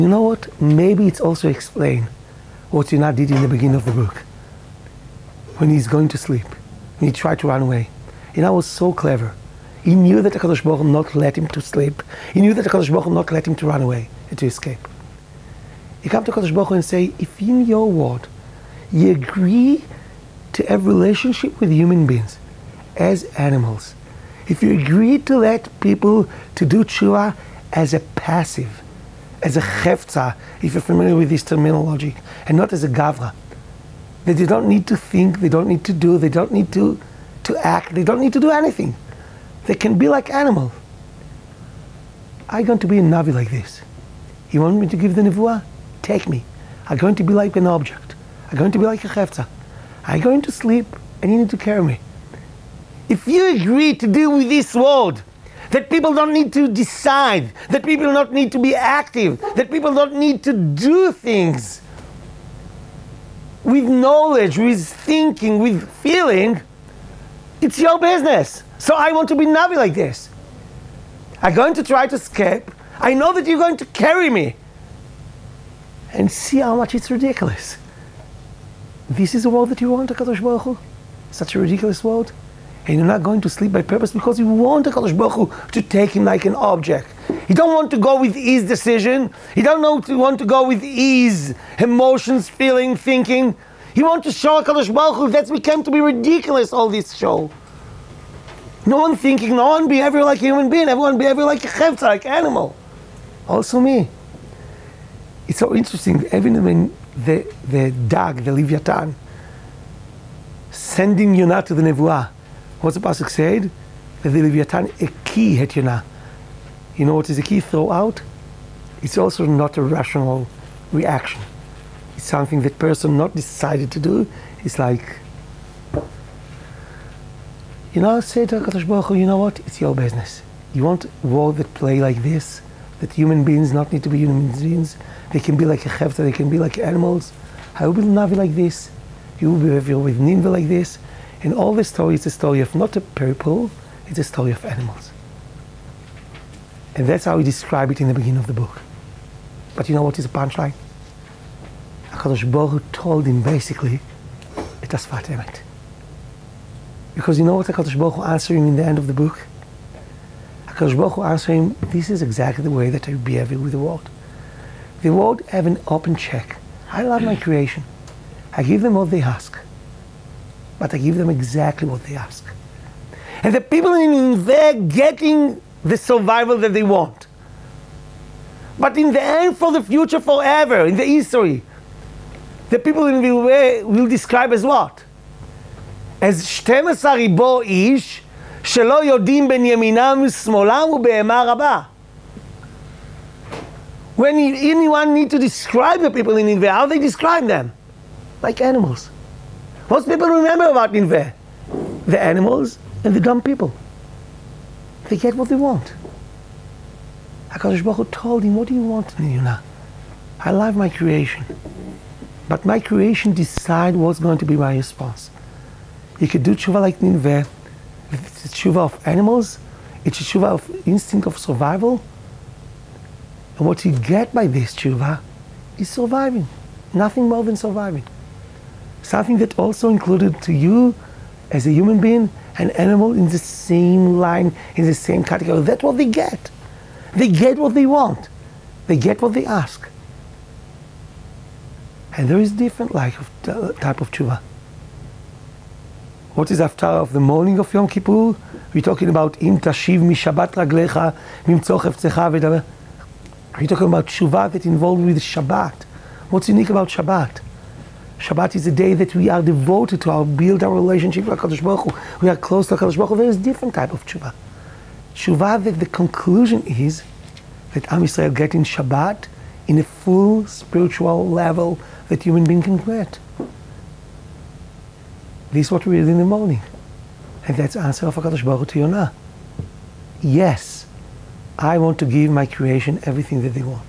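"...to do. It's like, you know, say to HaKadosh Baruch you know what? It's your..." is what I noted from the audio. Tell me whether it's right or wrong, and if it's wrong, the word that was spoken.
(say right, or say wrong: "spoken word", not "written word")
right.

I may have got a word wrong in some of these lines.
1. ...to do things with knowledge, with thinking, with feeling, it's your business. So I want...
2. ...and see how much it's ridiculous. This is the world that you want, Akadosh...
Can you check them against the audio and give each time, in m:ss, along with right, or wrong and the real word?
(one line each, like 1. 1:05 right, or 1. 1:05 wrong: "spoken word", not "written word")
1. 1:00 right
2. 1:16 right.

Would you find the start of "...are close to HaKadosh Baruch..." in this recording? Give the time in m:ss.
4:22.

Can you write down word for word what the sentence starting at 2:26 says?
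And that's how we describe it in the beginning of the book.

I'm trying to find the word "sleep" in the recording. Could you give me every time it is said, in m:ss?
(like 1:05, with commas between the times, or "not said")
0:06, 0:11, 0:50, 1:23.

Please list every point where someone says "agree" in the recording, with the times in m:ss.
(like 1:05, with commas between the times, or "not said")
0:19, 0:24, 0:53.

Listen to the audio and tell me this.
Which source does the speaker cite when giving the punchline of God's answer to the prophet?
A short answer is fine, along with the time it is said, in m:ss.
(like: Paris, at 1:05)
Sfat Emet, at 2:35.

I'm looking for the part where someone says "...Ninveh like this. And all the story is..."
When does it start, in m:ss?
2:20.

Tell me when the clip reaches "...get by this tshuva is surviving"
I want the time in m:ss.
3:43.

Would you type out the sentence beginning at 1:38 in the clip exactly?
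No one thinking, no one behaving like a human being, everyone behaving like a chevta, like animal.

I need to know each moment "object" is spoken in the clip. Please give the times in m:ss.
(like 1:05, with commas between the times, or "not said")
0:47, 1:26.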